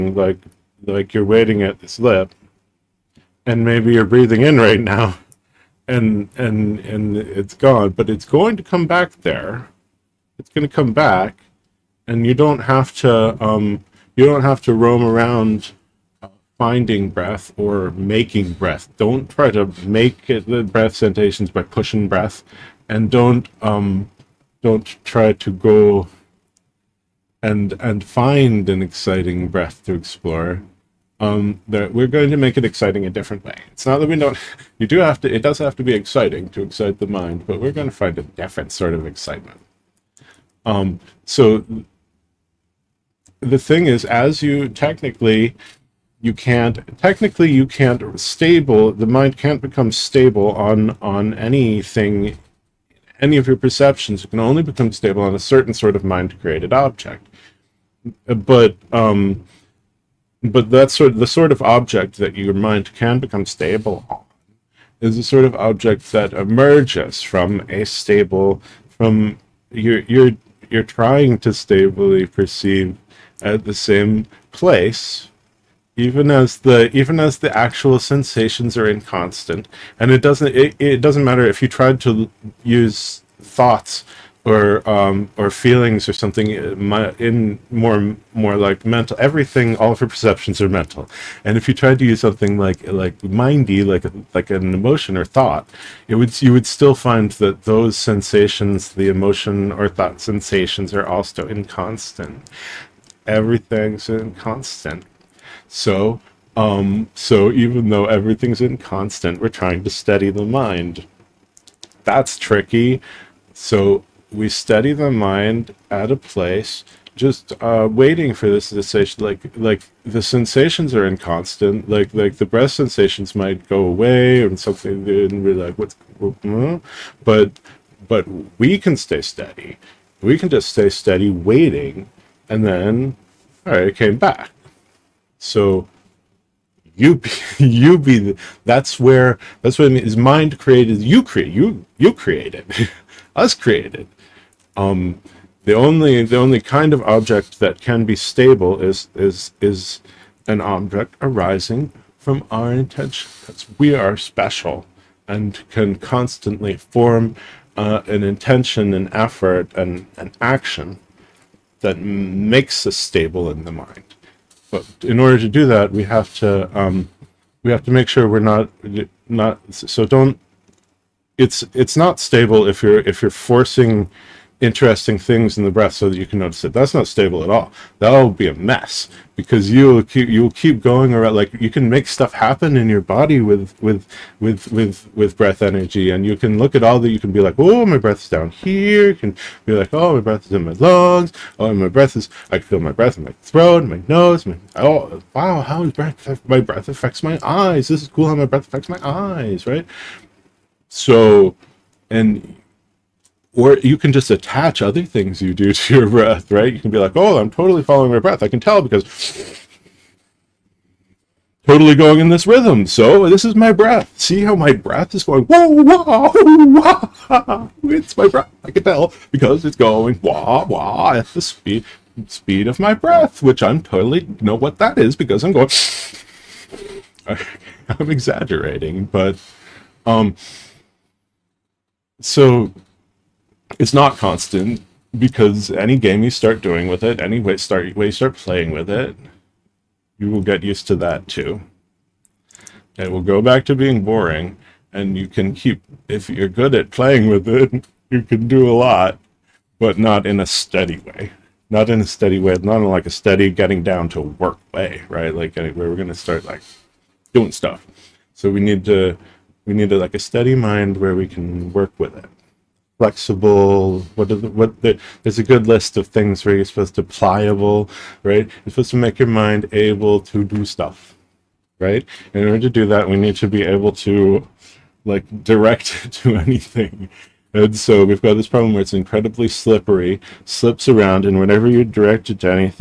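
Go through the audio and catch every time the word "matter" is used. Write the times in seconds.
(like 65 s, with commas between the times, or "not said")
81 s.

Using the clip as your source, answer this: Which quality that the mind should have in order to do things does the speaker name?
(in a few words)
Pliable.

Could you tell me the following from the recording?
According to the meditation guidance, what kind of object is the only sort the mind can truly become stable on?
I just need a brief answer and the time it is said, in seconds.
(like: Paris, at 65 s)
Mind-created object, at 56 s.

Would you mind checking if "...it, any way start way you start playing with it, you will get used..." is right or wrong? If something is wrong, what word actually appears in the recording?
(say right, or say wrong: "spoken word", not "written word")
right.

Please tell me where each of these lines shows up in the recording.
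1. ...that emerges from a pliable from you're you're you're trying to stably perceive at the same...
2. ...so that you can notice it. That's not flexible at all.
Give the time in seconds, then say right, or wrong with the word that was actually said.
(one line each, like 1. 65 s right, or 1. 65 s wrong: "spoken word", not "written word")
1. 66 s wrong: "stable", not "pliable"
2. 175 s wrong: "stable", not "flexible".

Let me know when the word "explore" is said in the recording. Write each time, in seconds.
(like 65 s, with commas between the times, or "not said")
29 s.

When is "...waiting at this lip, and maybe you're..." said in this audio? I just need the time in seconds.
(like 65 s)
1 s.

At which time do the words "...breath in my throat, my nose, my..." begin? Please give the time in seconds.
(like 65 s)
192 s.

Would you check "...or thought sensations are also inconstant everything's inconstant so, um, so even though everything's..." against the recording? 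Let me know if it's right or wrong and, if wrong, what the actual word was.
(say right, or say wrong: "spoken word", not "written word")
right.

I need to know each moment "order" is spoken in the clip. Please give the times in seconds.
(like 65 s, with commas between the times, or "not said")
165 s, 272 s.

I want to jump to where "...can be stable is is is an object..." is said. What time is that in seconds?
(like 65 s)
147 s.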